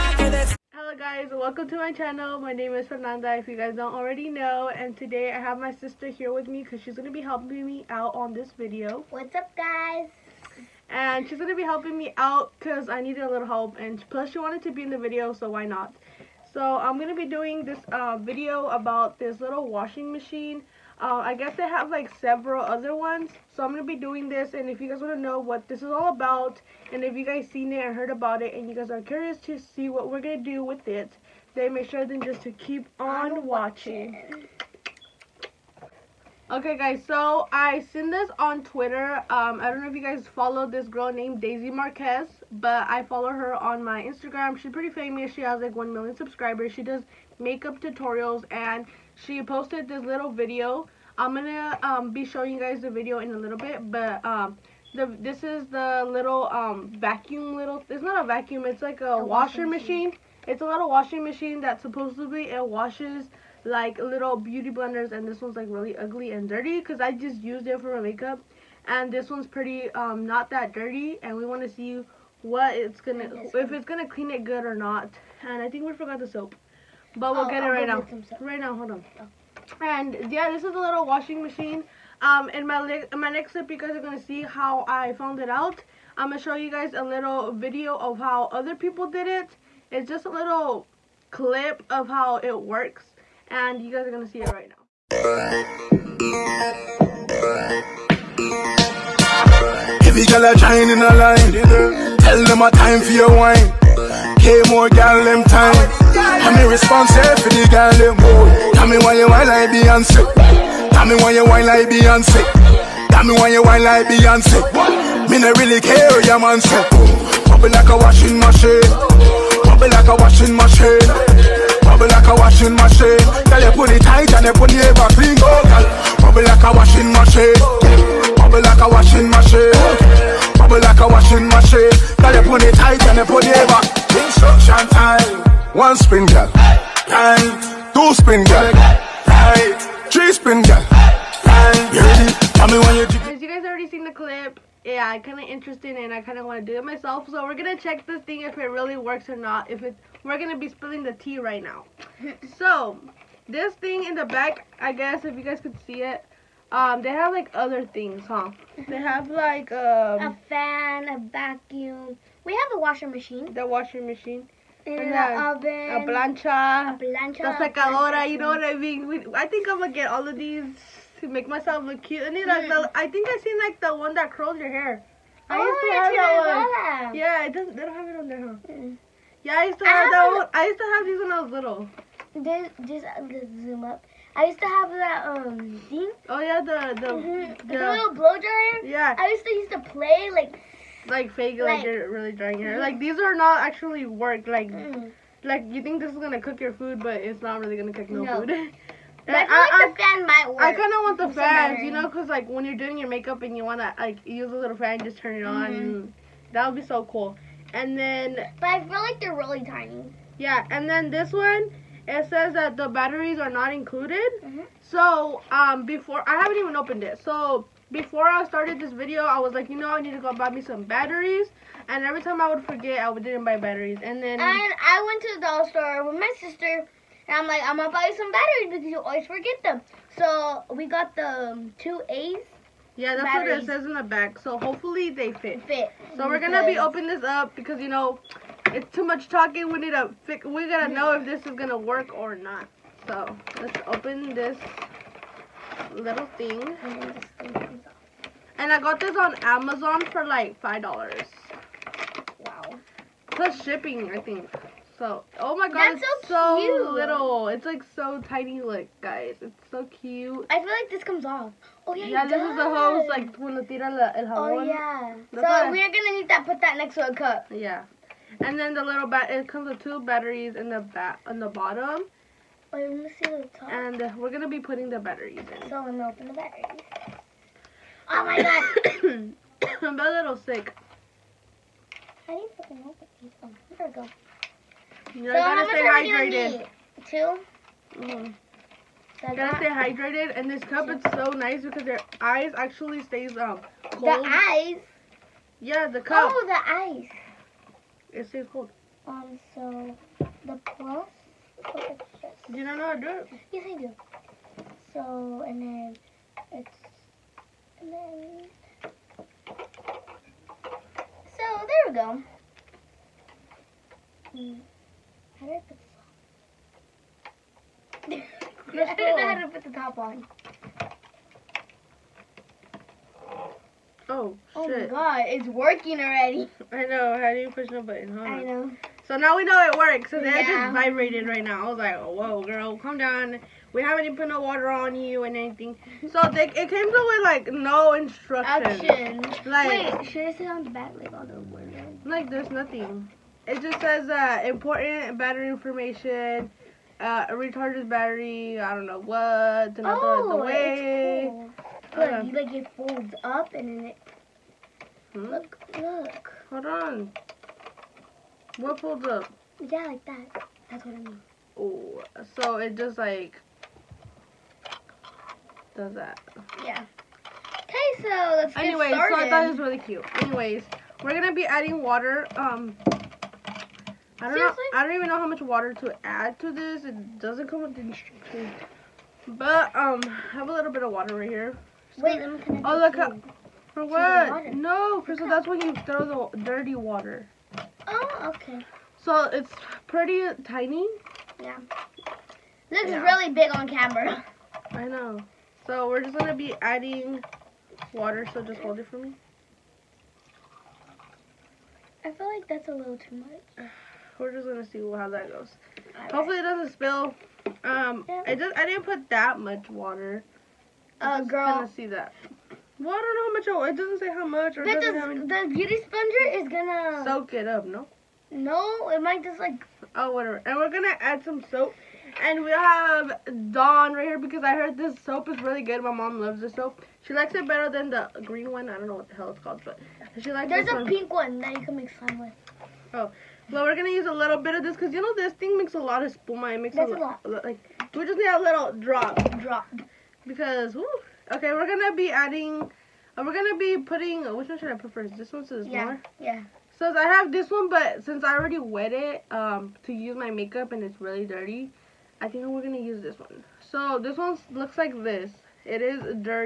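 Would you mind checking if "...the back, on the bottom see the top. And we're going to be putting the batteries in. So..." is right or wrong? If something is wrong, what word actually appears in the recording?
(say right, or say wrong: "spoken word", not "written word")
right.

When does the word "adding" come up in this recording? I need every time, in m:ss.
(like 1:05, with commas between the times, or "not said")
6:11, 6:36, 7:22.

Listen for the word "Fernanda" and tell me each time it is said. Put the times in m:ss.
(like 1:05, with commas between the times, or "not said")
0:02.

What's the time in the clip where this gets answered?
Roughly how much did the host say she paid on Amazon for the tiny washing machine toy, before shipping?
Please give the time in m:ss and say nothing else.
4:10.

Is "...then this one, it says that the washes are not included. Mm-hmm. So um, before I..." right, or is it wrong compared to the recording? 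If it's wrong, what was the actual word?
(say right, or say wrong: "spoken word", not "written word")
wrong: "batteries", not "washes".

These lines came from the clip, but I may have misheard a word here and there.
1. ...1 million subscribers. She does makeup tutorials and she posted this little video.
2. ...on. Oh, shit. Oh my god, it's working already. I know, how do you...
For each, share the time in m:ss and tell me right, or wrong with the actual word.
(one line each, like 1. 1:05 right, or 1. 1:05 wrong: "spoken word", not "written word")
1. 0:45 right
2. 5:19 right.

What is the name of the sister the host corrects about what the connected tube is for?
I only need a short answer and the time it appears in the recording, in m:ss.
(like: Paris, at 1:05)
Crystal, at 6:24.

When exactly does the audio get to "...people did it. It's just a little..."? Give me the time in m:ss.
1:28.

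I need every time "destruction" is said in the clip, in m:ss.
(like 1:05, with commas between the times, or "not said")
not said.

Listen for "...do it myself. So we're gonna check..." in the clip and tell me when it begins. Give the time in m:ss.
2:26.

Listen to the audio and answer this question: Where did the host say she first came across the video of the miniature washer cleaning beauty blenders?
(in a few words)
Twitter.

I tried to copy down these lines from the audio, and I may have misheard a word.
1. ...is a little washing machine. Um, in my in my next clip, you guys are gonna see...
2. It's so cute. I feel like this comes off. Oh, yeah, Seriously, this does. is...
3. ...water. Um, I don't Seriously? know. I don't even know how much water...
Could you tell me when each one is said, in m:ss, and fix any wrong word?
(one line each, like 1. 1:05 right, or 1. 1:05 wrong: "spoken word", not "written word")
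1. 1:20 right
2. 4:19 wrong: "Yeah", not "Seriously"
3. 6:11 right.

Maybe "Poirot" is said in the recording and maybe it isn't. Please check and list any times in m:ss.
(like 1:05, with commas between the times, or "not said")
not said.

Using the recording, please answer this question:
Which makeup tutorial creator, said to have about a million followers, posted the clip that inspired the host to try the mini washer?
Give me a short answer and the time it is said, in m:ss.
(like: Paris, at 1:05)
Daisy Marquez, at 0:41.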